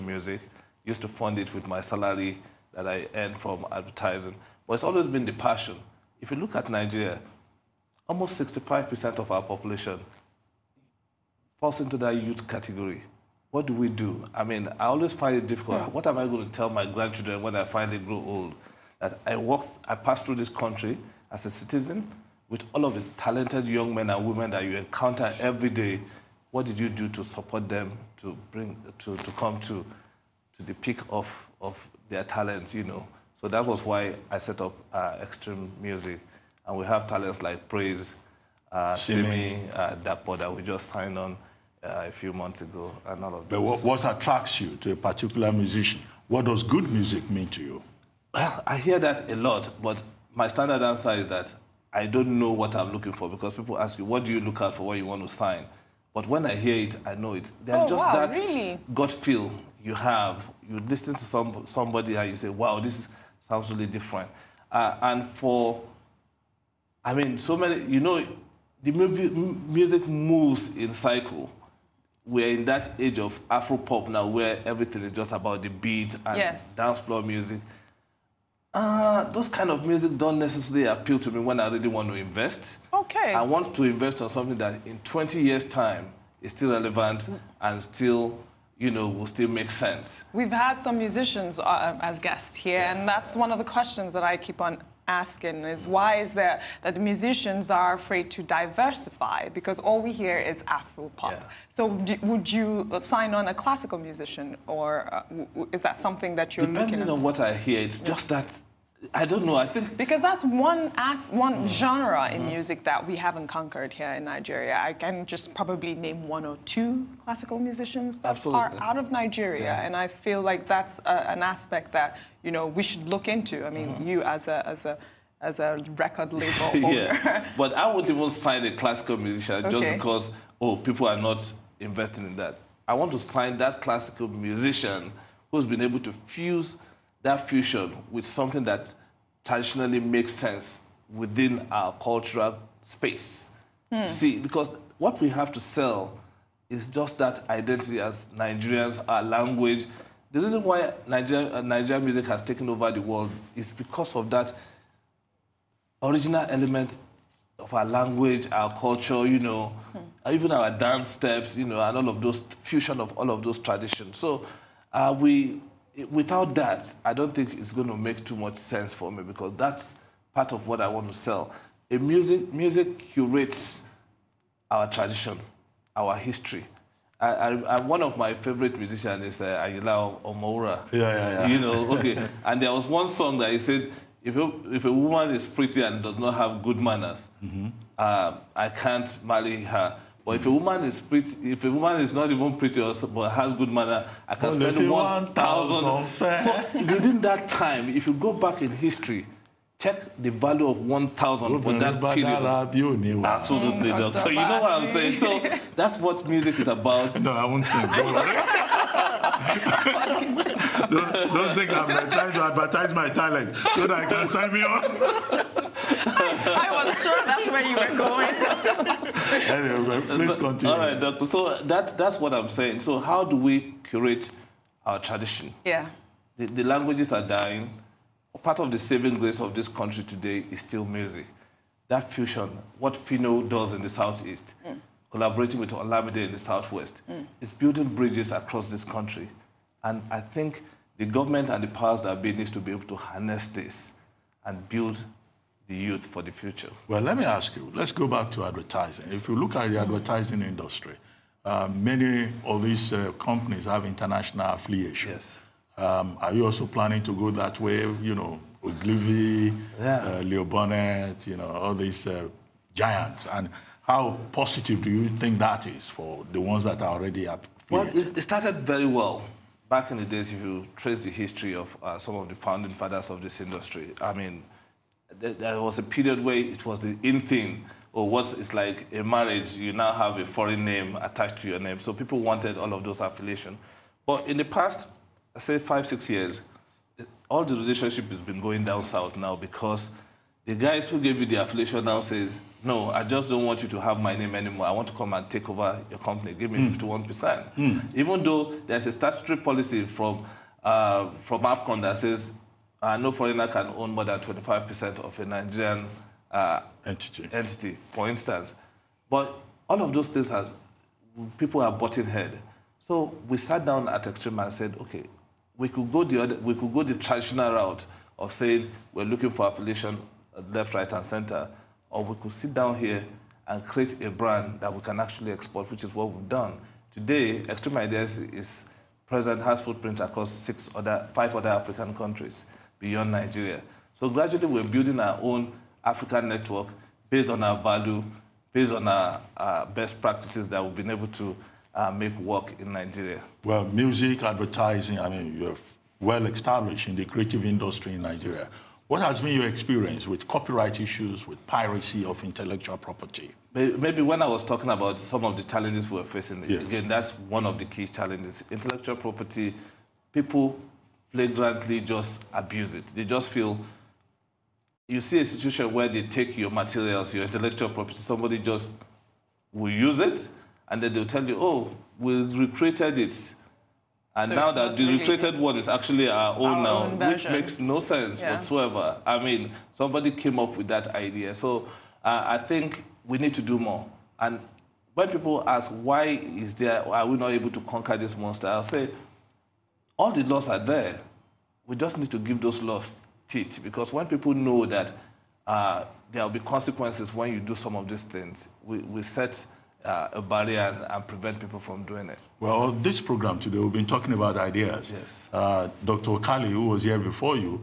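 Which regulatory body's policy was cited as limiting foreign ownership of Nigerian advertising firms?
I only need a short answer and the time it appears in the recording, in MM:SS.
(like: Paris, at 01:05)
APCON, at 05:01.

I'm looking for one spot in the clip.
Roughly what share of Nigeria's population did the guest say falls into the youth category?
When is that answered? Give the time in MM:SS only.
00:08.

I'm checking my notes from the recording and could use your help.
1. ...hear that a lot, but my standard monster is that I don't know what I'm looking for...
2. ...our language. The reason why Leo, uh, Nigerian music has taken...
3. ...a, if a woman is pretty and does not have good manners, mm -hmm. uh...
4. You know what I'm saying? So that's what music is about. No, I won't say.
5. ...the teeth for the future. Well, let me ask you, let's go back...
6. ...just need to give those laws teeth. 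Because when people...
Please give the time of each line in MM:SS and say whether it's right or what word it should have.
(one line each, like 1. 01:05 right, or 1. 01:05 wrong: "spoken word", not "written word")
1. 00:48 wrong: "answer", not "monster"
2. 02:29 wrong: "Nigeria", not "Leo"
3. 03:04 right
4. 03:24 right
5. 04:05 wrong: "youth", not "teeth"
6. 06:31 right.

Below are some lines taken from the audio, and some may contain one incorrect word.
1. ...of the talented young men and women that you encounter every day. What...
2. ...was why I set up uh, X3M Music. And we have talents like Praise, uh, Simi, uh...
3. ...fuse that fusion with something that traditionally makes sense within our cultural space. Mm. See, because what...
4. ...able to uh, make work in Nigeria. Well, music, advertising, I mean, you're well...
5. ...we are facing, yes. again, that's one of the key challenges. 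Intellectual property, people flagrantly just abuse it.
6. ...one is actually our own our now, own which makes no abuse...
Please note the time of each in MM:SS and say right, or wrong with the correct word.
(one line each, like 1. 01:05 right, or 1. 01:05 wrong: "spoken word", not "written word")
1. 00:22 right
2. 00:33 right
3. 02:16 right
4. 05:40 right
5. 05:55 right
6. 06:15 wrong: "sense", not "abuse".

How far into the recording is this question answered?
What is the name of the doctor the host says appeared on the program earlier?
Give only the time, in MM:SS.
06:45.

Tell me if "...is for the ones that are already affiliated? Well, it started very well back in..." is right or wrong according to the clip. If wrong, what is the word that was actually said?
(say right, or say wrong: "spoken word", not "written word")
right.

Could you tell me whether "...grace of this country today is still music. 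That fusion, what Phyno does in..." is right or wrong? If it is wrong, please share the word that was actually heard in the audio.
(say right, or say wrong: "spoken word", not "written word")
right.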